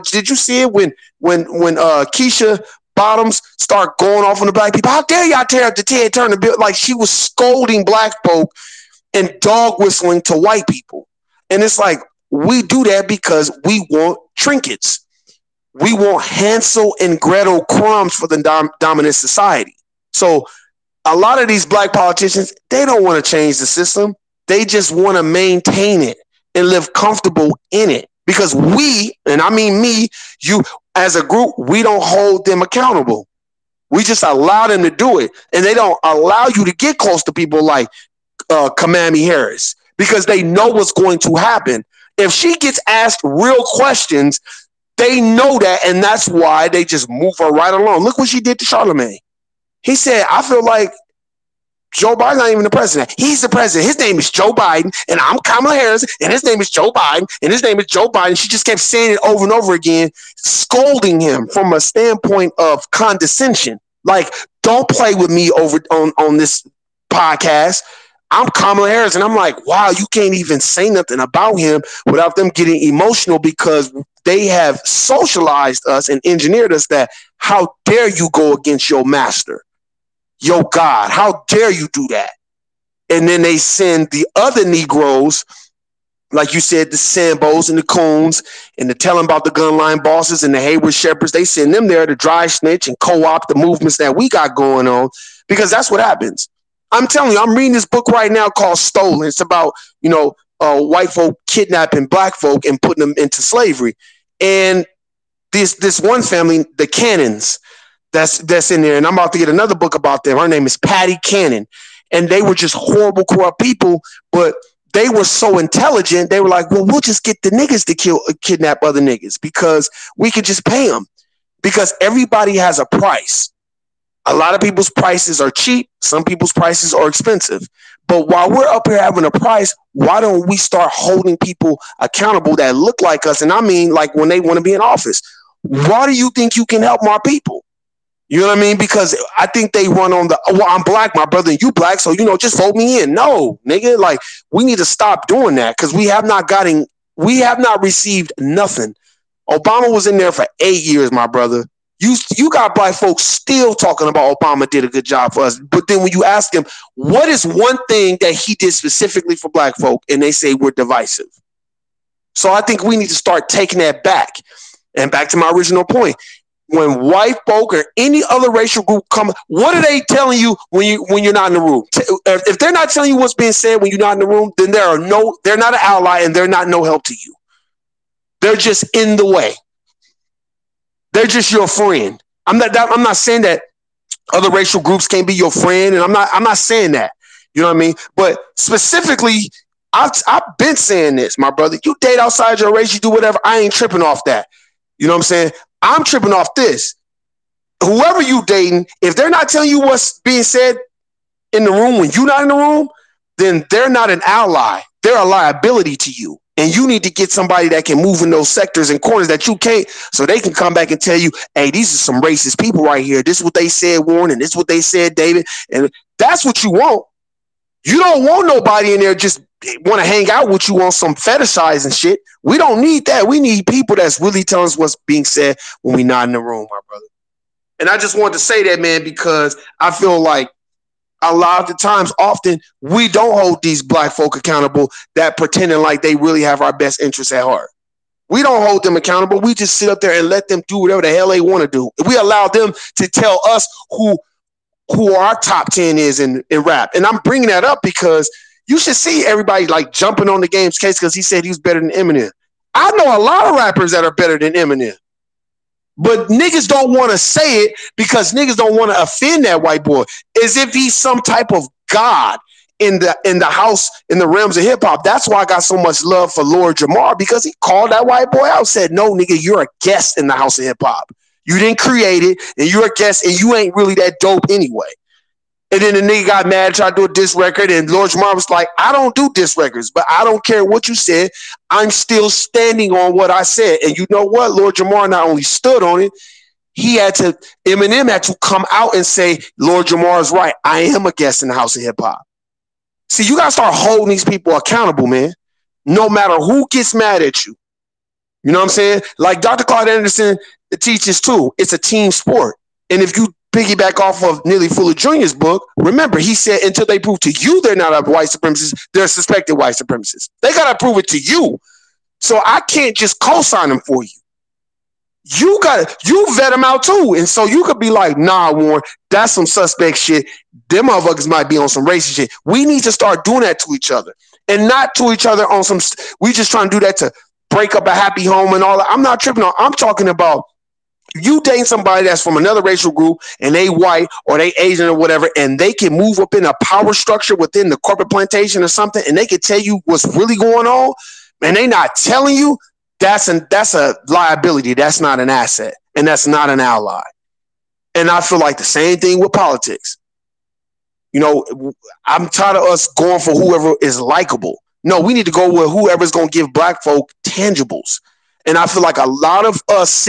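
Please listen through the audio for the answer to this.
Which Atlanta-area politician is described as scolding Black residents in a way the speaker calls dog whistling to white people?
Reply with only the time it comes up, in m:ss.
0:02.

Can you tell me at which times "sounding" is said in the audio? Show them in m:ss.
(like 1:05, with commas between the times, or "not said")
not said.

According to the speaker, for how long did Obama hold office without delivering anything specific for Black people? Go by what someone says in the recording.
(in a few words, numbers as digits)
8 years.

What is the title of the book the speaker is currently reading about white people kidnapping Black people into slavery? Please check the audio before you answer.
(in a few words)
Stolen.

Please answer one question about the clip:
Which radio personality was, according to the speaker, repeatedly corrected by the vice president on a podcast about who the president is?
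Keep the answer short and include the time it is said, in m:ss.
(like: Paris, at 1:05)
Charlemagne, at 0:48.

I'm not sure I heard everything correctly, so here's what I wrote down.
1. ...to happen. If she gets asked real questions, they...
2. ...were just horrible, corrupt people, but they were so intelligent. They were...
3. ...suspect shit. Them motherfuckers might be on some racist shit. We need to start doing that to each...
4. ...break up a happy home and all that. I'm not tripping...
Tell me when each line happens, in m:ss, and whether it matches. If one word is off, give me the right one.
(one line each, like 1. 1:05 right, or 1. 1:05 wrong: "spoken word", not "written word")
1. 0:41 right
2. 1:52 right
3. 5:19 right
4. 5:27 right.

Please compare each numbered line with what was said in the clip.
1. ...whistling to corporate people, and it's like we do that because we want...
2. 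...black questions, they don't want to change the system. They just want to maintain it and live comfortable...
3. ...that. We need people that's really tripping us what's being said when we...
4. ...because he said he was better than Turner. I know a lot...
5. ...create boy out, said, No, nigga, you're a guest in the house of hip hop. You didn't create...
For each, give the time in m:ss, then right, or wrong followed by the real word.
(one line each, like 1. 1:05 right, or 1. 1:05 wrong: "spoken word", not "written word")
1. 0:09 wrong: "white", not "corporate"
2. 0:21 wrong: "politicians", not "questions"
3. 3:43 wrong: "telling", not "tripping"
4. 4:10 wrong: "Eminem", not "Turner"
5. 4:28 wrong: "white", not "create".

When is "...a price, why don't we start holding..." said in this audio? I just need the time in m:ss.
2:09.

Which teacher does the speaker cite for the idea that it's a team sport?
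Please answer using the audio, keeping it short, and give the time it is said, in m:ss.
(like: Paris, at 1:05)
Dr. Claude Anderson, at 4:59.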